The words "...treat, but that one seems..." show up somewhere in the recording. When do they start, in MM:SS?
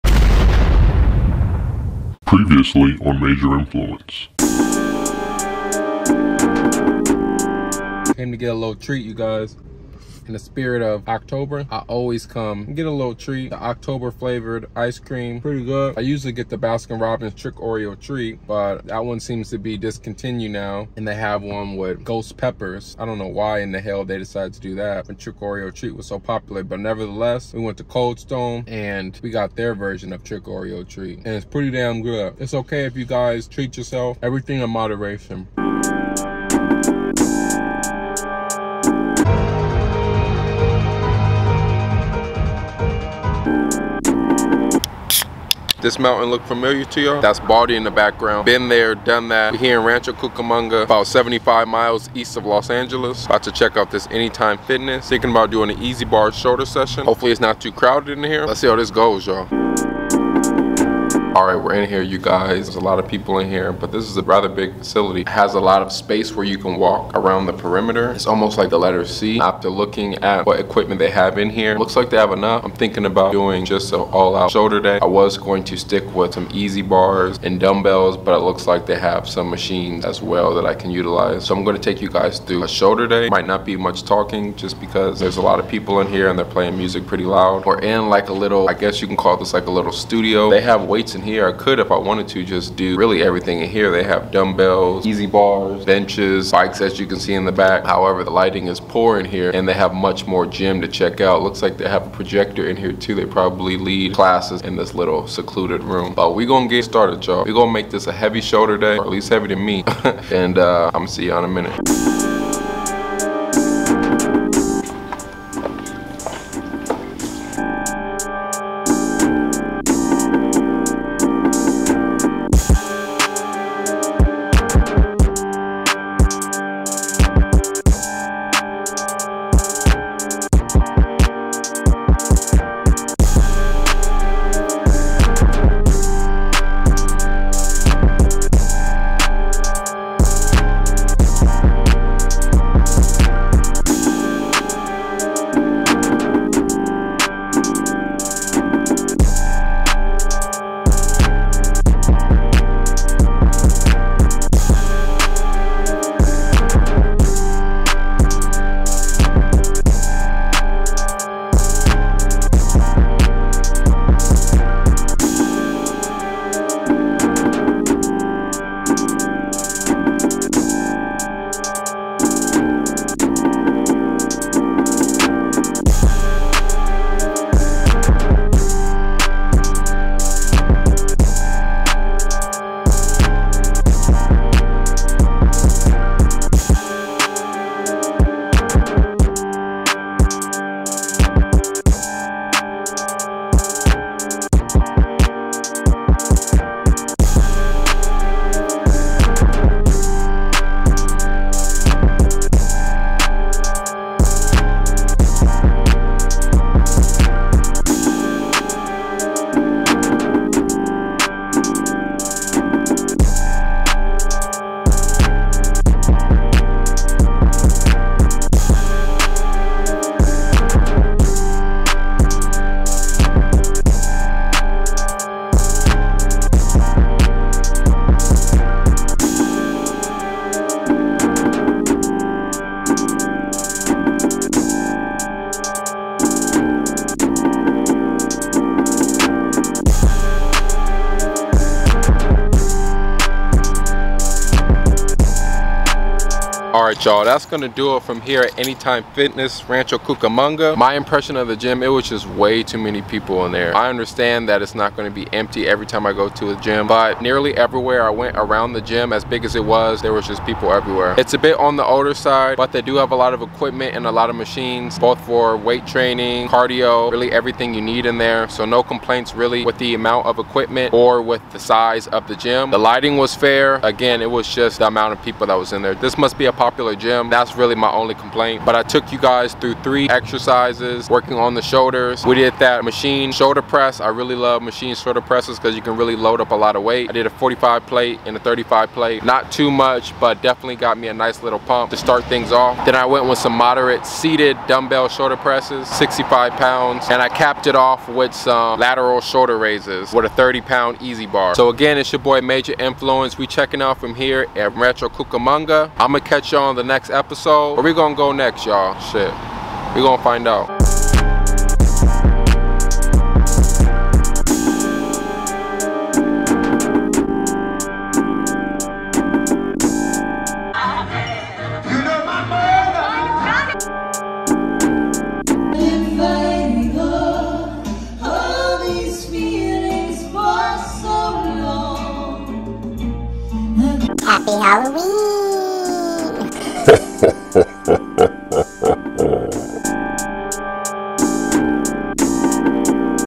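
00:17.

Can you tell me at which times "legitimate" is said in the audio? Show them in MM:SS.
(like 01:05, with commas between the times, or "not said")
not said.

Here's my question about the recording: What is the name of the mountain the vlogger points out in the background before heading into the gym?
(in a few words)
Baldy.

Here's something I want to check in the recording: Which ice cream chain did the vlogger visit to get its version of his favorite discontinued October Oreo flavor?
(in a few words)
Cold Stone.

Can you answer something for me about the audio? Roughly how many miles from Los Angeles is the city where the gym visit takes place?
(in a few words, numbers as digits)
75 miles.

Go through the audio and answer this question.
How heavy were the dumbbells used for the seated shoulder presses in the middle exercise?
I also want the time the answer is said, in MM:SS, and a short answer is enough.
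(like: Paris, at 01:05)
65 pounds, at 04:55.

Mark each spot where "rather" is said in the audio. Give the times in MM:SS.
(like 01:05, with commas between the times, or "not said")
01:04.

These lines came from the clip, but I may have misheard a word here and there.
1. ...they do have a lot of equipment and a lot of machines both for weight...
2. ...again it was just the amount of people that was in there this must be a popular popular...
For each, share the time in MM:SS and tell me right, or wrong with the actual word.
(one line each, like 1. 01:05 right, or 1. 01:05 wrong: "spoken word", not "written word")
1. 04:22 right
2. 04:33 right.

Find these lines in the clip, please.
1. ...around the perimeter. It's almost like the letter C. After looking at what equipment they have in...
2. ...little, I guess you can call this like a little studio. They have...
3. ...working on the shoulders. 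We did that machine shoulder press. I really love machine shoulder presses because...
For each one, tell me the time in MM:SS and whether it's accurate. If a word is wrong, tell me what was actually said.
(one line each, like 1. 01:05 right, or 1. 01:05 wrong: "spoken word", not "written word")
1. 01:07 right
2. 01:28 right
3. 04:41 right.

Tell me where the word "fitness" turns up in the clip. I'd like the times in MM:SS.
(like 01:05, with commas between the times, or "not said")
00:54, 04:09.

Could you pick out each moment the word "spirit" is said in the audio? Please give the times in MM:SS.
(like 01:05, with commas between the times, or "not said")
00:10.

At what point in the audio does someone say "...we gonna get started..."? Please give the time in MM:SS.
01:46.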